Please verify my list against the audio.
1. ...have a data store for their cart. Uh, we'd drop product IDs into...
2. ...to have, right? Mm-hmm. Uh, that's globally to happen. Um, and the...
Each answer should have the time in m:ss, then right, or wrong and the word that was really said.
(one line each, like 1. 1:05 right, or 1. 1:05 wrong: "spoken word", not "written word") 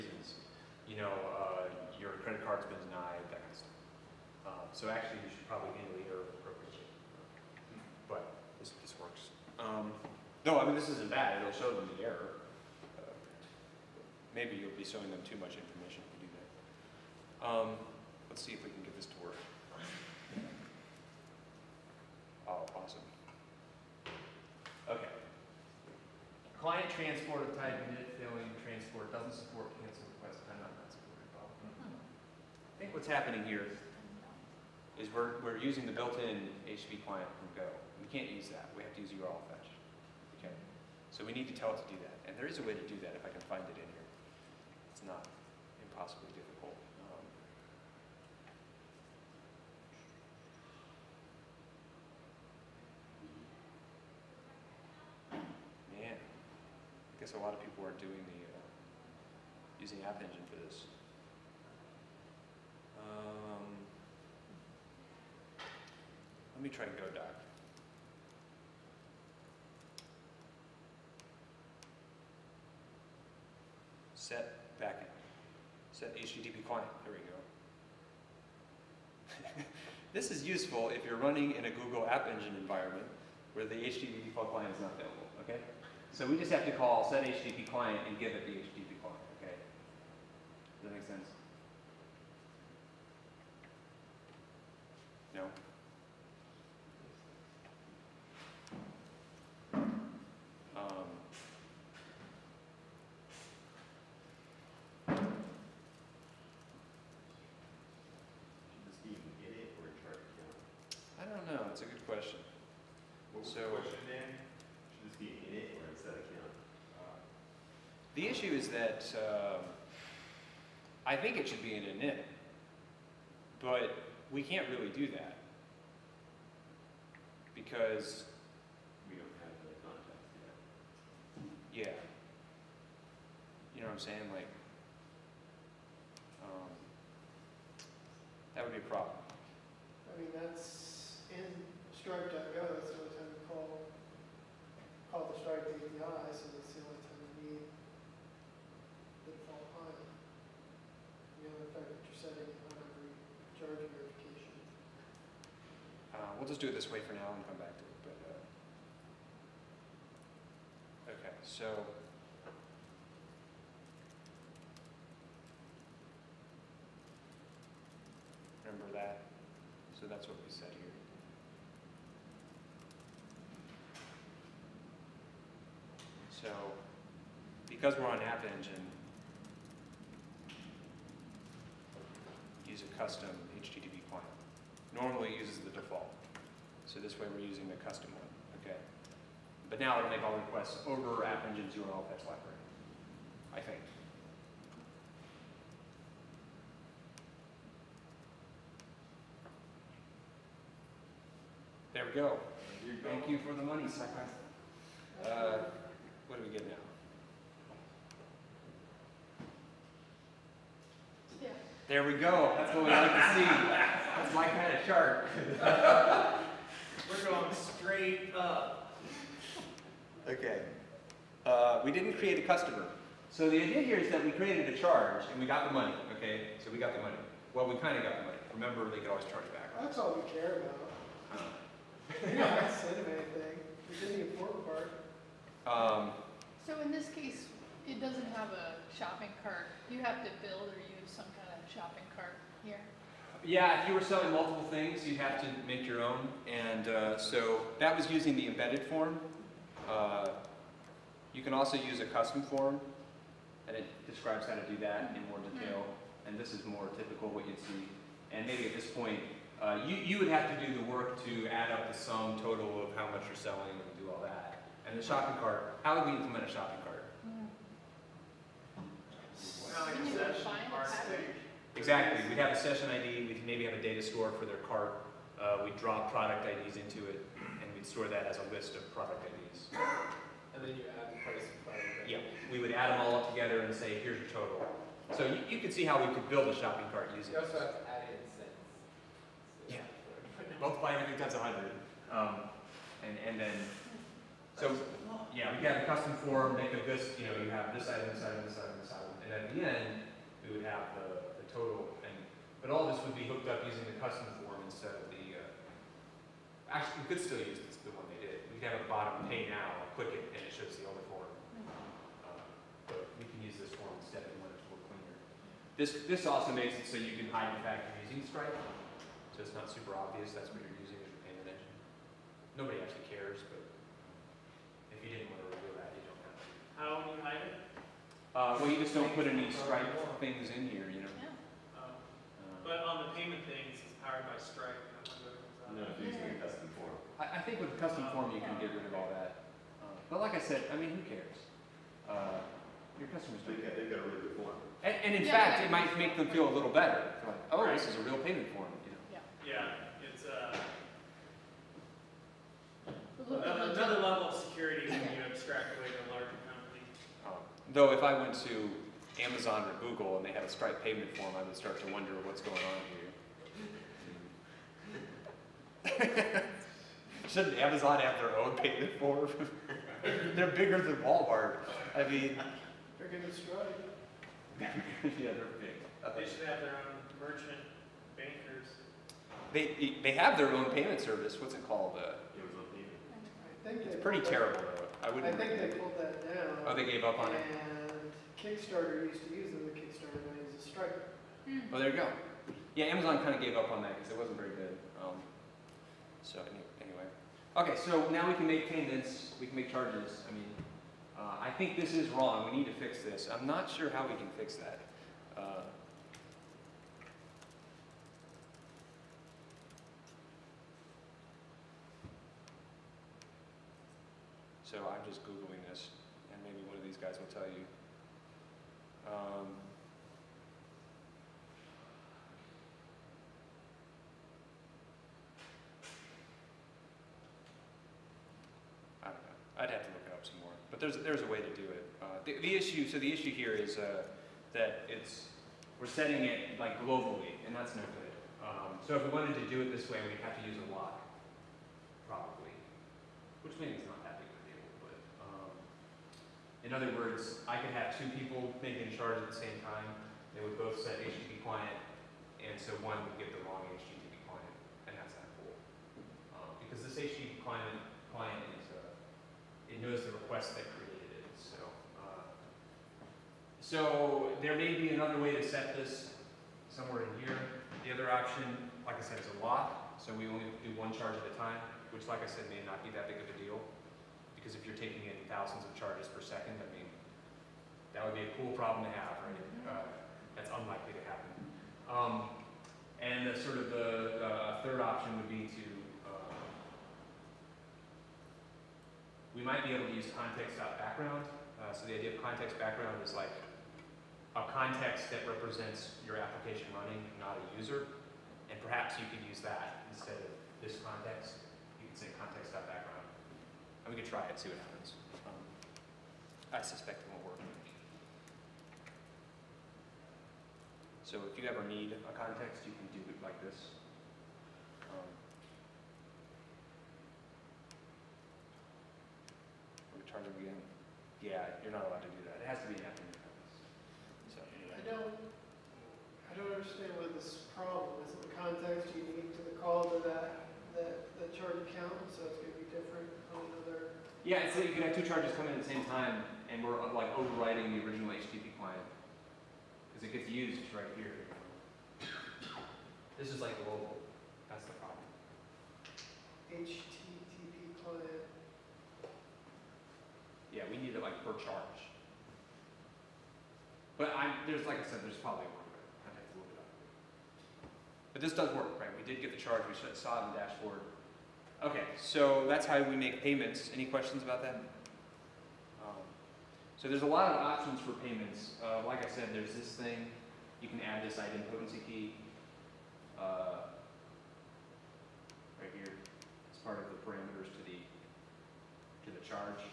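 1. 4:33 right
2. 7:58 wrong: "unlikely", not "globally".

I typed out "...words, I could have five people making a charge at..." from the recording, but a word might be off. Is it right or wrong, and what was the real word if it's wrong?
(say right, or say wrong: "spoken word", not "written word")
wrong: "two", not "five".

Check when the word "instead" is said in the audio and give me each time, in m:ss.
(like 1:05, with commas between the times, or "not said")
5:04, 5:14, 8:19.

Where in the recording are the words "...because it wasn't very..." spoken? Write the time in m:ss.
6:33.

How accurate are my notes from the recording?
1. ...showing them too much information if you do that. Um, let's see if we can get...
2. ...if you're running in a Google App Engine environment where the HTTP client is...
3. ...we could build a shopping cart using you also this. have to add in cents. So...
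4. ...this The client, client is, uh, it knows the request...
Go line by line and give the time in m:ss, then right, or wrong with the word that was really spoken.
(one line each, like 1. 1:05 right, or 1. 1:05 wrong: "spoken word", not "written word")
1. 0:14 right
2. 1:20 right
3. 4:46 right
4. 7:36 wrong: "HTTP", not "The".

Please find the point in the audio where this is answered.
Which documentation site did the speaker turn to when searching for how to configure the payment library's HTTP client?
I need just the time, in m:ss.
1:06.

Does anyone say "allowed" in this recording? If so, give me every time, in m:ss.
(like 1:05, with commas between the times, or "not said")
8:41.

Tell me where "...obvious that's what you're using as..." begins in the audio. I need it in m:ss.
5:19.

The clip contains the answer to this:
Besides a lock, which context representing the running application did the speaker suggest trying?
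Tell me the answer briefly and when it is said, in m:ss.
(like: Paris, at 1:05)
context.background, at 8:10.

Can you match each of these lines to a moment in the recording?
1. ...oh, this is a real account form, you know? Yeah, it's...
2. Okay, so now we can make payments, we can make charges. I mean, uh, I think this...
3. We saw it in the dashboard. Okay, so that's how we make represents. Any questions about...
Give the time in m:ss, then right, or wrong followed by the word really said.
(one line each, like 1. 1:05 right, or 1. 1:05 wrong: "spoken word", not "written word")
1. 5:47 wrong: "payment", not "account"
2. 6:37 right
3. 9:19 wrong: "payments", not "represents".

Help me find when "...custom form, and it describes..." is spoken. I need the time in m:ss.
4:12.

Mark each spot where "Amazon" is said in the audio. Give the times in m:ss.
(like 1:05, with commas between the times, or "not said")
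5:59, 6:07, 6:32.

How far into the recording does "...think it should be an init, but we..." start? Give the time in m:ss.
2:01.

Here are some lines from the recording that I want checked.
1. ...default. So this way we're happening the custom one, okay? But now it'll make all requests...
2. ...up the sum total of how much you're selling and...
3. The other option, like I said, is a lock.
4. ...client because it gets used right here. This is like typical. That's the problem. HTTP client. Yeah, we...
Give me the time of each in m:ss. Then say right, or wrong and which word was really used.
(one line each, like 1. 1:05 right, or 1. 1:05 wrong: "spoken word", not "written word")
1. 3:05 wrong: "using", not "happening"
2. 4:21 right
3. 7:47 right
4. 8:58 wrong: "global", not "typical".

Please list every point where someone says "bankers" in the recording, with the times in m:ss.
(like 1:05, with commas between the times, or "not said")
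6:18.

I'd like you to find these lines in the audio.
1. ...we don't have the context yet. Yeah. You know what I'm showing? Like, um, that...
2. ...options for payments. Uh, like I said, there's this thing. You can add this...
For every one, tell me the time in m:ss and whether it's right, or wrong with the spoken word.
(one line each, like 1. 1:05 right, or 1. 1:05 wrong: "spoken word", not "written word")
1. 2:09 wrong: "saying", not "showing"
2. 9:27 right.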